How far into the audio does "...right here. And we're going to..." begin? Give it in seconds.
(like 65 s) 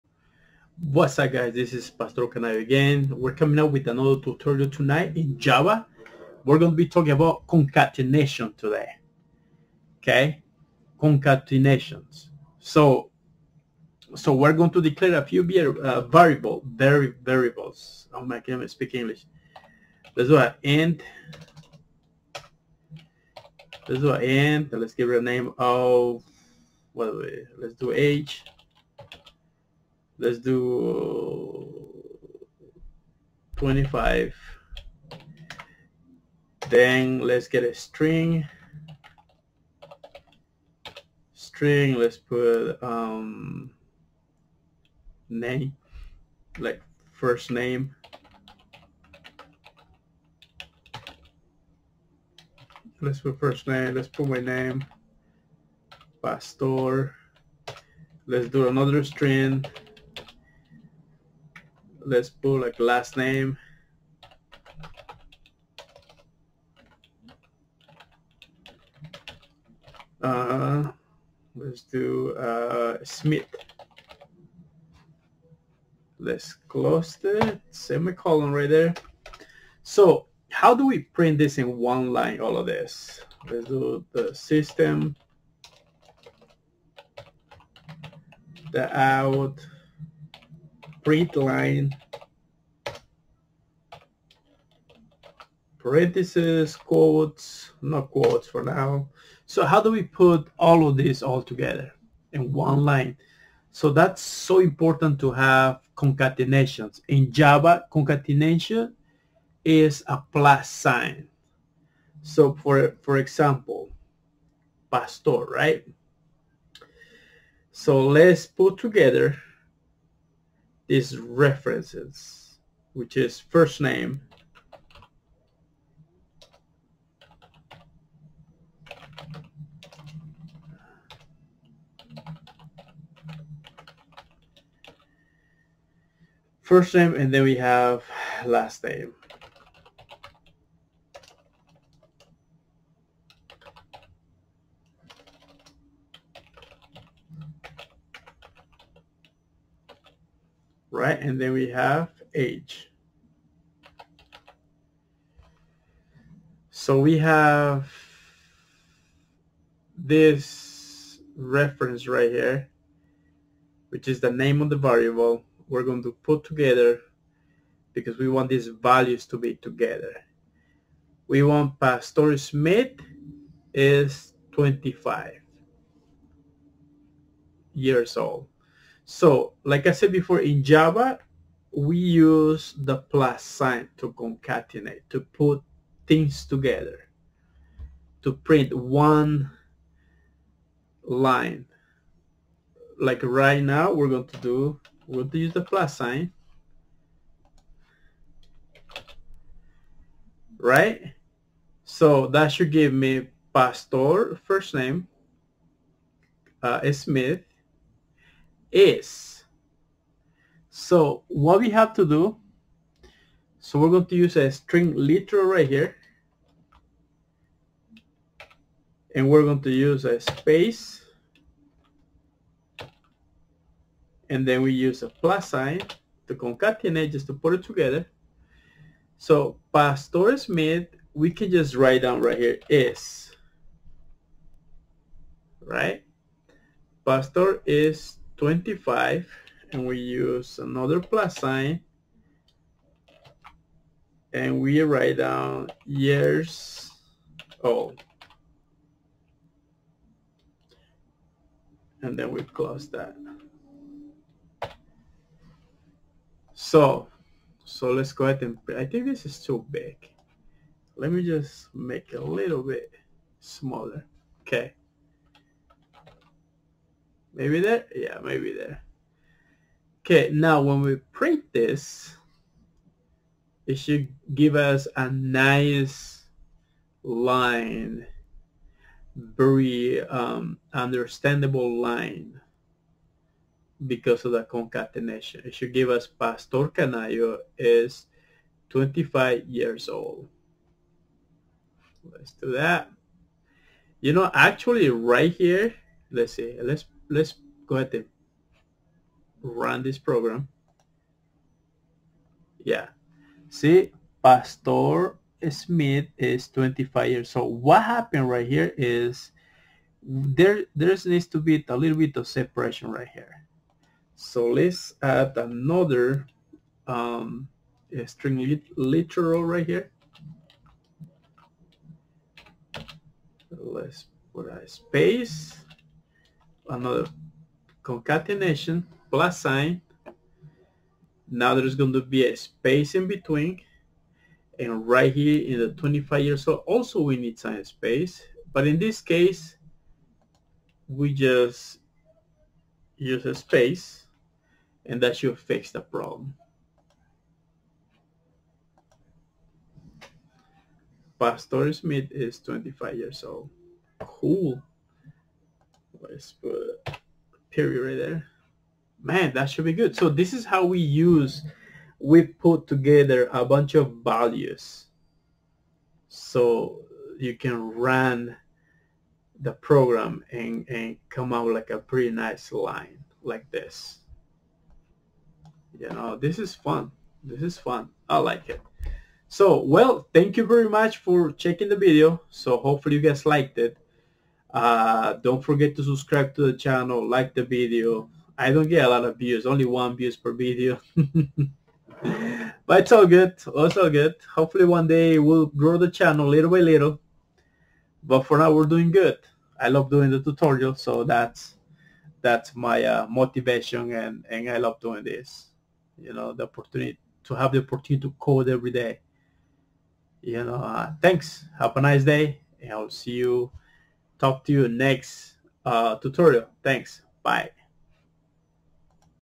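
215 s.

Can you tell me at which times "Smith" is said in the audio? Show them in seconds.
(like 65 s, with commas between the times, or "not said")
73 s, 172 s, 206 s, 230 s, 305 s, 351 s.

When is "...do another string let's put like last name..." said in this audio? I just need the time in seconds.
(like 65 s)
58 s.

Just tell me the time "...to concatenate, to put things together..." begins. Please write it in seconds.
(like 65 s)
183 s.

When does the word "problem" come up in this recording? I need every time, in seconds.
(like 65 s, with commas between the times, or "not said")
345 s.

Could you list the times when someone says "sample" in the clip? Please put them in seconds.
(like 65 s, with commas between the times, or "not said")
not said.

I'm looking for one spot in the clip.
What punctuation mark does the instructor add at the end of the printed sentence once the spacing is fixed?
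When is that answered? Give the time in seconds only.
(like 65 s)
357 s.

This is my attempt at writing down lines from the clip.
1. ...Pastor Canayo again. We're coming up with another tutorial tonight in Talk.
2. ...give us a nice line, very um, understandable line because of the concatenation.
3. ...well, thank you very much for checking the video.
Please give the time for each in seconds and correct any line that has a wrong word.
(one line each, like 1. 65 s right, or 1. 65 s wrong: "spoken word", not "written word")
1. 1 s wrong: "Java", not "Talk"
2. 274 s right
3. 379 s right.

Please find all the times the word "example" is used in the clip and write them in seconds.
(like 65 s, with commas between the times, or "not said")
113 s.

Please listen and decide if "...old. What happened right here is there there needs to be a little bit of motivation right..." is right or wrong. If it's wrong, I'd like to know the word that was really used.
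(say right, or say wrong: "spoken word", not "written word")
wrong: "separation", not "motivation".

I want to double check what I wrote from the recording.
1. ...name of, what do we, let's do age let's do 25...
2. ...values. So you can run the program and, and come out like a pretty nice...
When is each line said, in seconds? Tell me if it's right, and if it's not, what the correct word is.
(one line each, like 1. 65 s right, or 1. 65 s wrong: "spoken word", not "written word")
1. 25 s right
2. 364 s right.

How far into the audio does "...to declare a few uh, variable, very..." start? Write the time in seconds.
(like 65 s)
14 s.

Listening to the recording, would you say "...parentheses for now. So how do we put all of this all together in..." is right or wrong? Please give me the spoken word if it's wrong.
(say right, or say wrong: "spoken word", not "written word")
wrong: "quotes", not "parentheses".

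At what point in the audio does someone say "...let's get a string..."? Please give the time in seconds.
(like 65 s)
37 s.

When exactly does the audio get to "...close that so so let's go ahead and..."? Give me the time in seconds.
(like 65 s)
252 s.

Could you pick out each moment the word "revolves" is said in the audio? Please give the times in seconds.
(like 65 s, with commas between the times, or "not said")
not said.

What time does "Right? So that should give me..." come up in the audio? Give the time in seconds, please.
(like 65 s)
200 s.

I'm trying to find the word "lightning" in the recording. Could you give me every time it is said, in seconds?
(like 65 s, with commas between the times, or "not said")
not said.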